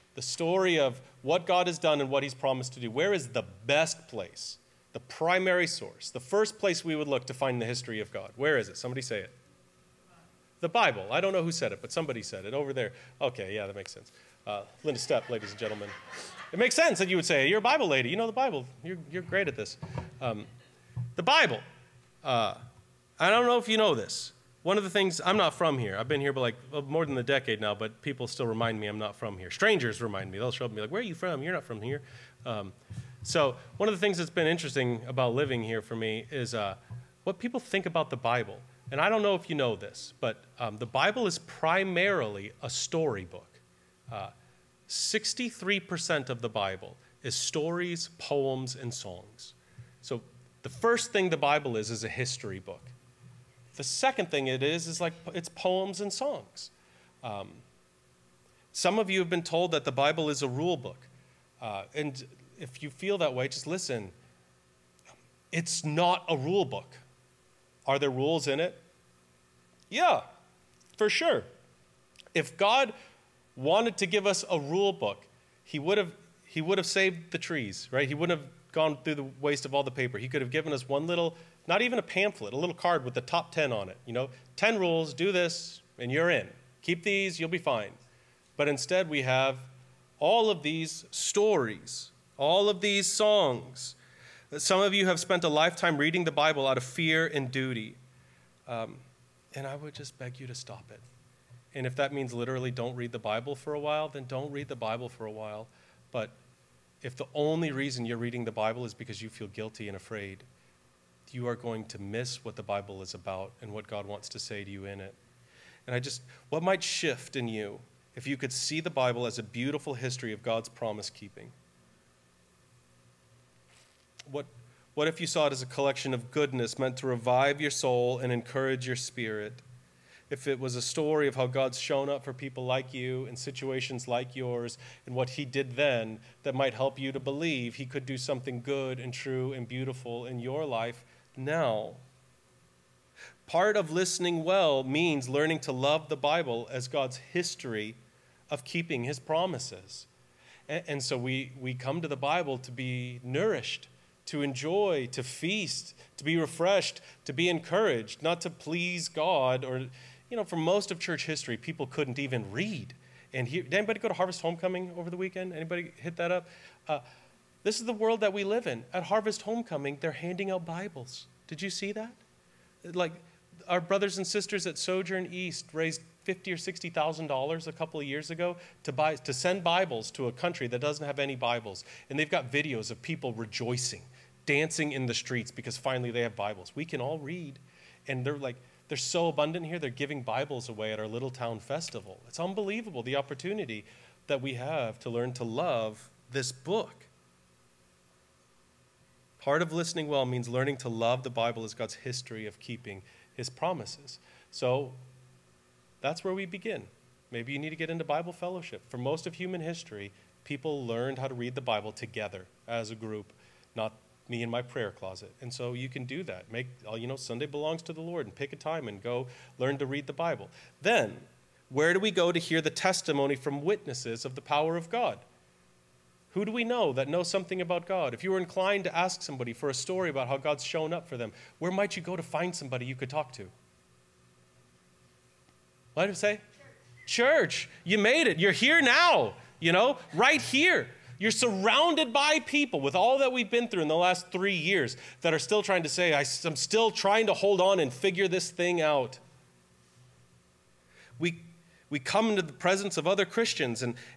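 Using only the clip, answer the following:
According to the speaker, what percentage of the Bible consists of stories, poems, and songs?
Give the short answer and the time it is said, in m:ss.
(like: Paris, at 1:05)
63%, at 0:44.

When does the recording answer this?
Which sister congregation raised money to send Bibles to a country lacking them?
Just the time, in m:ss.
2:54.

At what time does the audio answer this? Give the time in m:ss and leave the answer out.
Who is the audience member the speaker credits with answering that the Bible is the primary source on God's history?
0:14.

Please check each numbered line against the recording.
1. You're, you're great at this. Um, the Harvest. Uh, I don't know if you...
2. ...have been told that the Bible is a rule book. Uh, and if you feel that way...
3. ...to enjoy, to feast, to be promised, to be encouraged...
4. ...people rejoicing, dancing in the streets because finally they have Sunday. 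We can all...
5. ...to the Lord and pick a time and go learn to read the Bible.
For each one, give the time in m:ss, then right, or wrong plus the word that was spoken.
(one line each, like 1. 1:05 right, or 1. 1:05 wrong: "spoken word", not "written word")
1. 0:18 wrong: "Bible", not "Harvest"
2. 0:59 right
3. 2:34 wrong: "refreshed", not "promised"
4. 3:03 wrong: "Bibles", not "Sunday"
5. 3:37 right.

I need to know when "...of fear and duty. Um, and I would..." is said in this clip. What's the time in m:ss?
1:36.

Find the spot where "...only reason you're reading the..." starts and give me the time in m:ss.
1:47.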